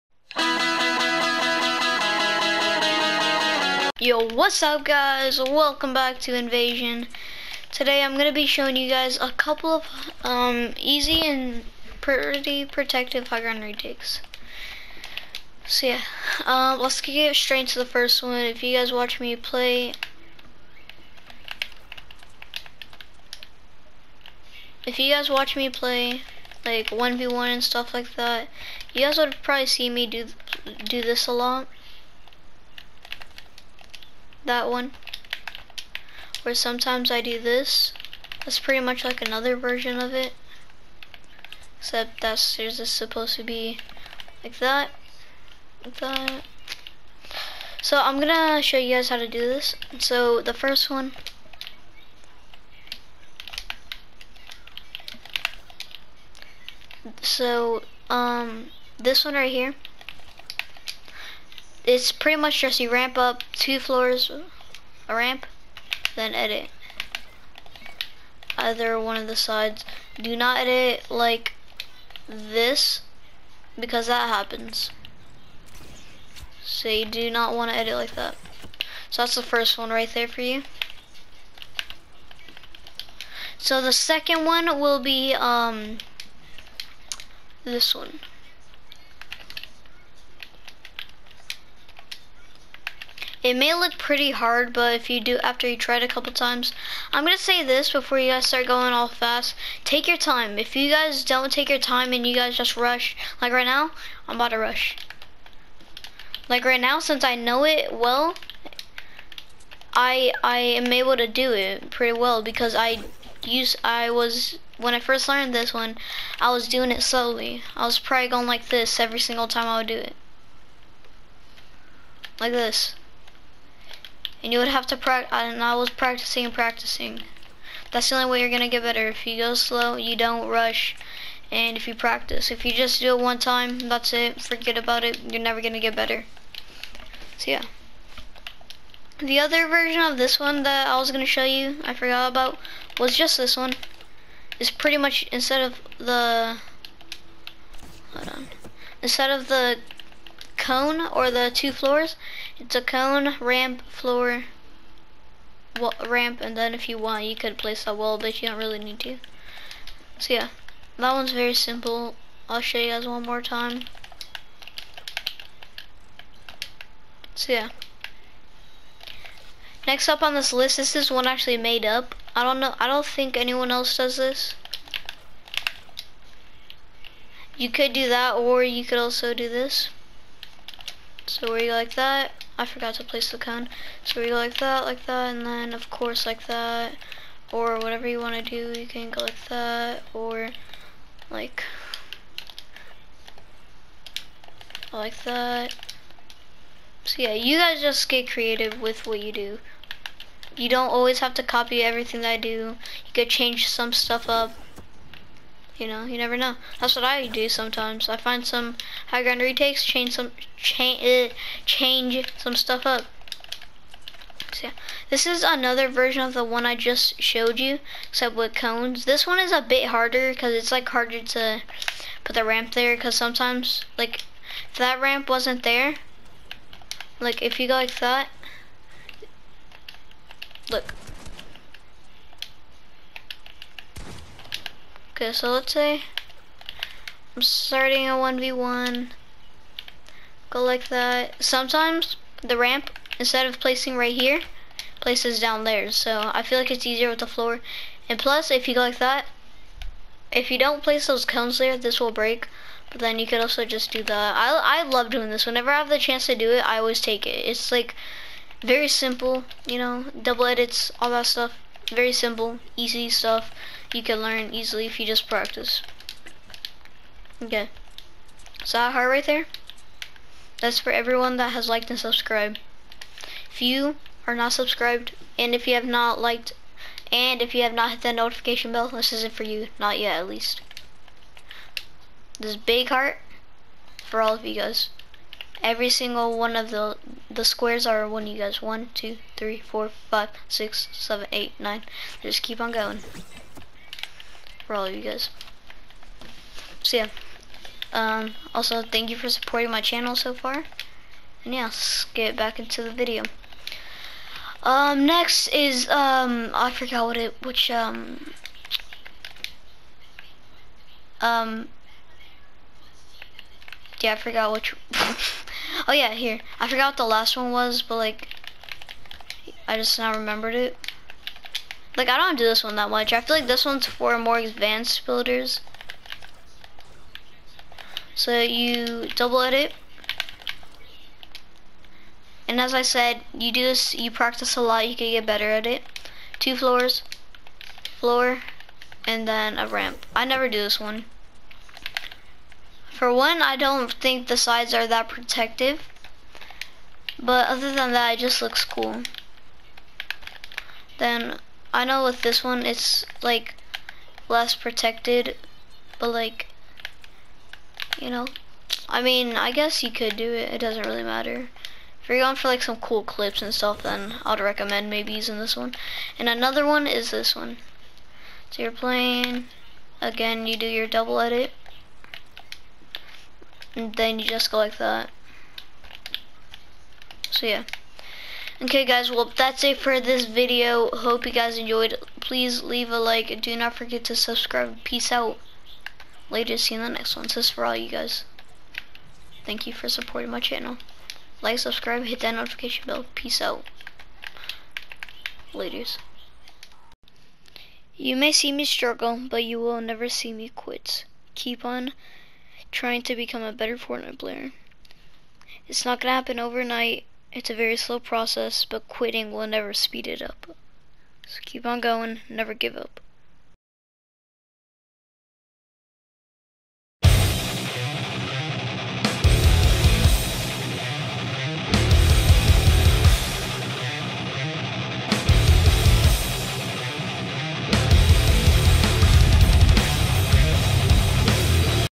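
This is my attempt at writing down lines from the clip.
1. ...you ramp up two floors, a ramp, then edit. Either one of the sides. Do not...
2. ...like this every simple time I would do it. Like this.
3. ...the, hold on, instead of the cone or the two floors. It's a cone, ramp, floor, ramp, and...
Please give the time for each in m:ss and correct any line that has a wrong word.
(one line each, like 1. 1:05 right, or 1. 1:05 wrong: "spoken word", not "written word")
1. 1:02 right
2. 1:58 wrong: "single", not "simple"
3. 2:25 right.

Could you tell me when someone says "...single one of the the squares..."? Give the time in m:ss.
4:45.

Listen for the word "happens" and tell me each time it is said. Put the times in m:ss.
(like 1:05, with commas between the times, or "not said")
1:14, 6:46.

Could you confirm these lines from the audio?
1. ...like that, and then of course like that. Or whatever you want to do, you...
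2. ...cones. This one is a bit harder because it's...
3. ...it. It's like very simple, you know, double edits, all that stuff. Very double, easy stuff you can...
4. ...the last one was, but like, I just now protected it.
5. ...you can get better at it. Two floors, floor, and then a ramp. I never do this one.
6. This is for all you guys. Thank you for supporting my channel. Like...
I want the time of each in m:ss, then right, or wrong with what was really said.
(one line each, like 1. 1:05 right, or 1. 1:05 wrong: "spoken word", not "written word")
1. 3:04 right
2. 3:38 right
3. 4:17 wrong: "simple", not "double"
4. 5:16 wrong: "remembered", not "protected"
5. 5:34 right
6. 6:27 right.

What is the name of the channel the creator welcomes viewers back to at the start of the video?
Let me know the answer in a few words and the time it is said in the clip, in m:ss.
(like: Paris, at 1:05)
Invasion, at 0:06.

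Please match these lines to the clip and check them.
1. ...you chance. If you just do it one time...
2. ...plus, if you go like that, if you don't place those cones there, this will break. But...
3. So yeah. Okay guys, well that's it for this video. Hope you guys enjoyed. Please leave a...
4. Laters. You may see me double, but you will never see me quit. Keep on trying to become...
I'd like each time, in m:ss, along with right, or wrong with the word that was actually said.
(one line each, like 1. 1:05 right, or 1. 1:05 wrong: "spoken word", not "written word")
1. 2:11 wrong: "practice", not "chance"
2. 4:08 right
3. 6:17 right
4. 6:35 wrong: "struggle", not "double".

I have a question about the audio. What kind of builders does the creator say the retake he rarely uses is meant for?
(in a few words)
advanced builders.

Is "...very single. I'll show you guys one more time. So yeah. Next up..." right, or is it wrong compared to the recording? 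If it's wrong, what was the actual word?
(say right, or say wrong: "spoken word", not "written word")
wrong: "simple", not "single".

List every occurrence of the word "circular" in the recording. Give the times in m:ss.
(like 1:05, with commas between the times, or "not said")
not said.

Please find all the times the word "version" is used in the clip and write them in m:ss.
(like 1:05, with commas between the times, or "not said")
0:39, 2:19, 3:35.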